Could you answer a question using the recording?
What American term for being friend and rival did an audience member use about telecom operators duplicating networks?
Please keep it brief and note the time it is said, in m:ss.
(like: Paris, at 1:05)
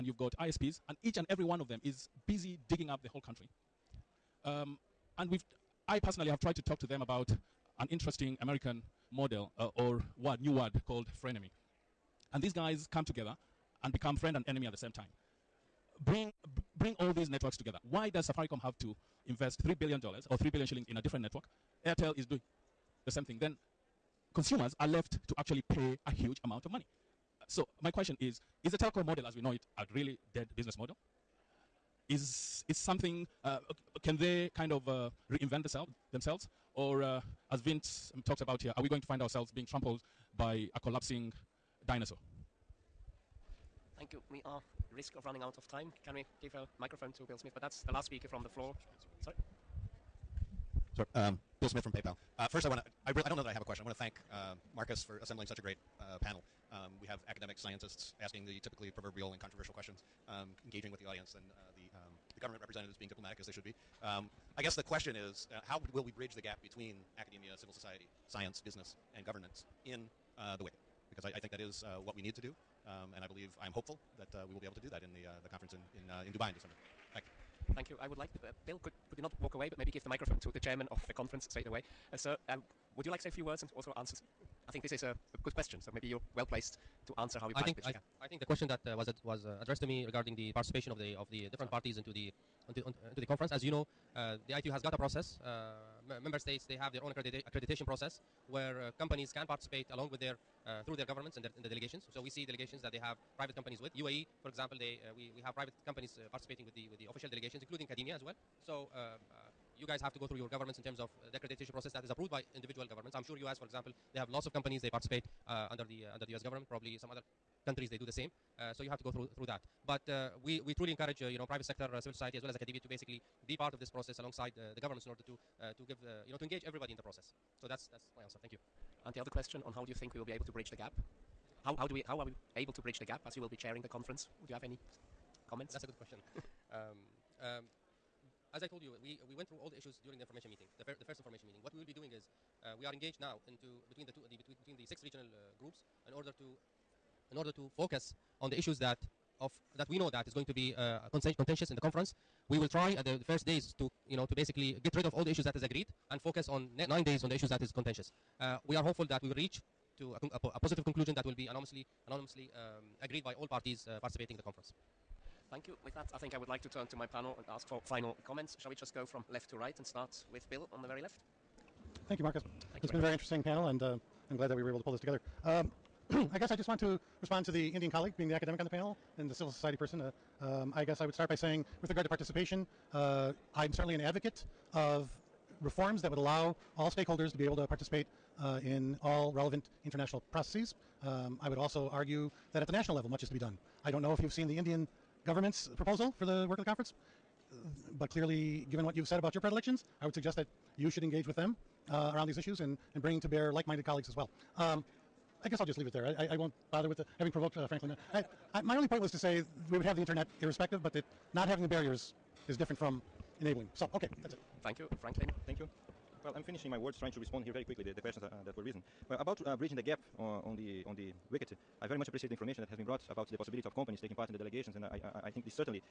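frenemy, at 0:11.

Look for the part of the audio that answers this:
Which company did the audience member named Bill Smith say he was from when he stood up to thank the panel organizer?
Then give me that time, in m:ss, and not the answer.
0:51.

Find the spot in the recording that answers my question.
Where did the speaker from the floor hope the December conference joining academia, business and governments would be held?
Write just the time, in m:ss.
1:16.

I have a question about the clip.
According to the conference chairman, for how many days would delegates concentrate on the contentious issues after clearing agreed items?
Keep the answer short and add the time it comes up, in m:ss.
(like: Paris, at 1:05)
9, at 2:36.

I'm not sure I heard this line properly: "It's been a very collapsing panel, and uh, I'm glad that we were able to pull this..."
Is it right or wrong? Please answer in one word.
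wrong.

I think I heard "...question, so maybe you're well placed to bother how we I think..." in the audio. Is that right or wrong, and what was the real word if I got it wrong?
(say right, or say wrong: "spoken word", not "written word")
wrong: "answer", not "bother".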